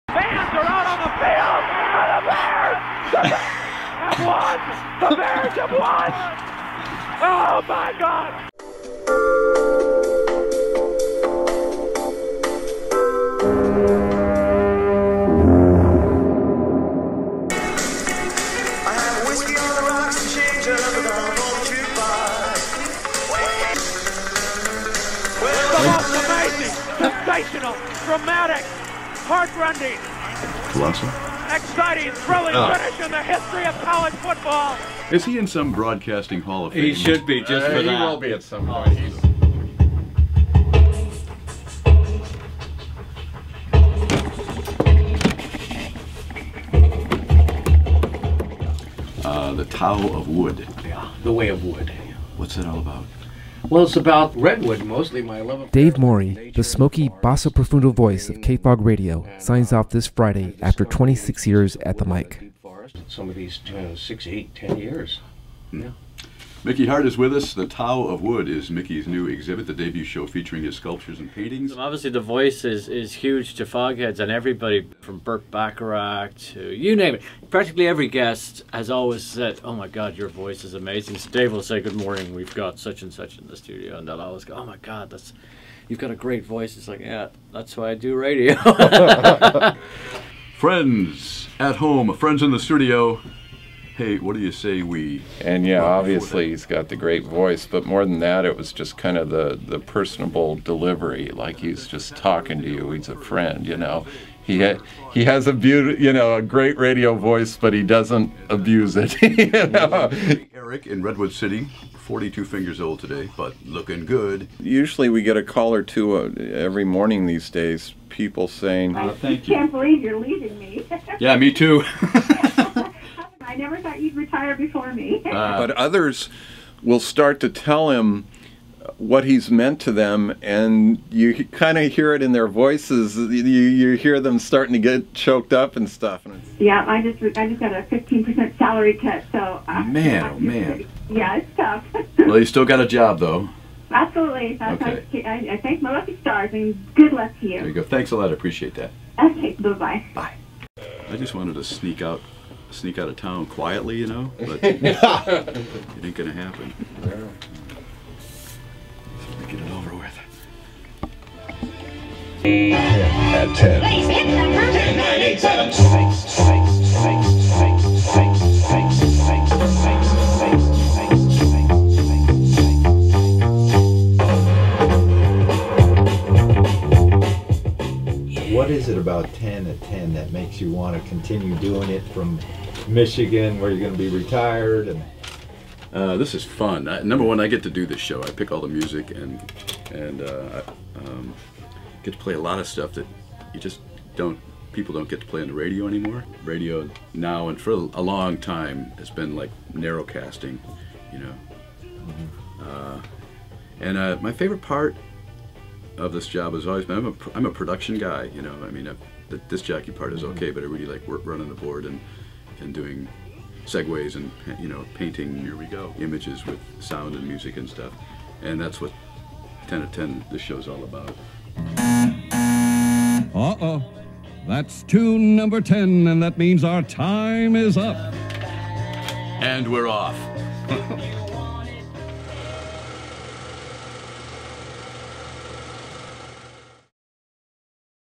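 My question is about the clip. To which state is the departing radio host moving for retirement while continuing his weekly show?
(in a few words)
Michigan.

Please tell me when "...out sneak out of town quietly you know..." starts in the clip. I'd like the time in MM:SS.
02:32.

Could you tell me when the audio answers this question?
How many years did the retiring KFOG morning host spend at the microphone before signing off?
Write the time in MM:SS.
01:00.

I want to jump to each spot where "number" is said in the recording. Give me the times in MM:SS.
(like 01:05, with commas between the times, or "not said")
03:07, 03:45.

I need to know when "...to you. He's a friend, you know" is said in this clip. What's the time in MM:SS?
01:42.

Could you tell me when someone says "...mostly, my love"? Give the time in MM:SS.
00:54.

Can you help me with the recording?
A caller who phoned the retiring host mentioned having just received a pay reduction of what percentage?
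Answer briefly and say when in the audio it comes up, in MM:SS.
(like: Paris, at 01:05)
15%, at 02:17.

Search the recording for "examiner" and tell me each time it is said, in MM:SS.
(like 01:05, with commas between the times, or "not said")
not said.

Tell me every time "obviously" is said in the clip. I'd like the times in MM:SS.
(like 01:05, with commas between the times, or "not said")
01:11, 01:35.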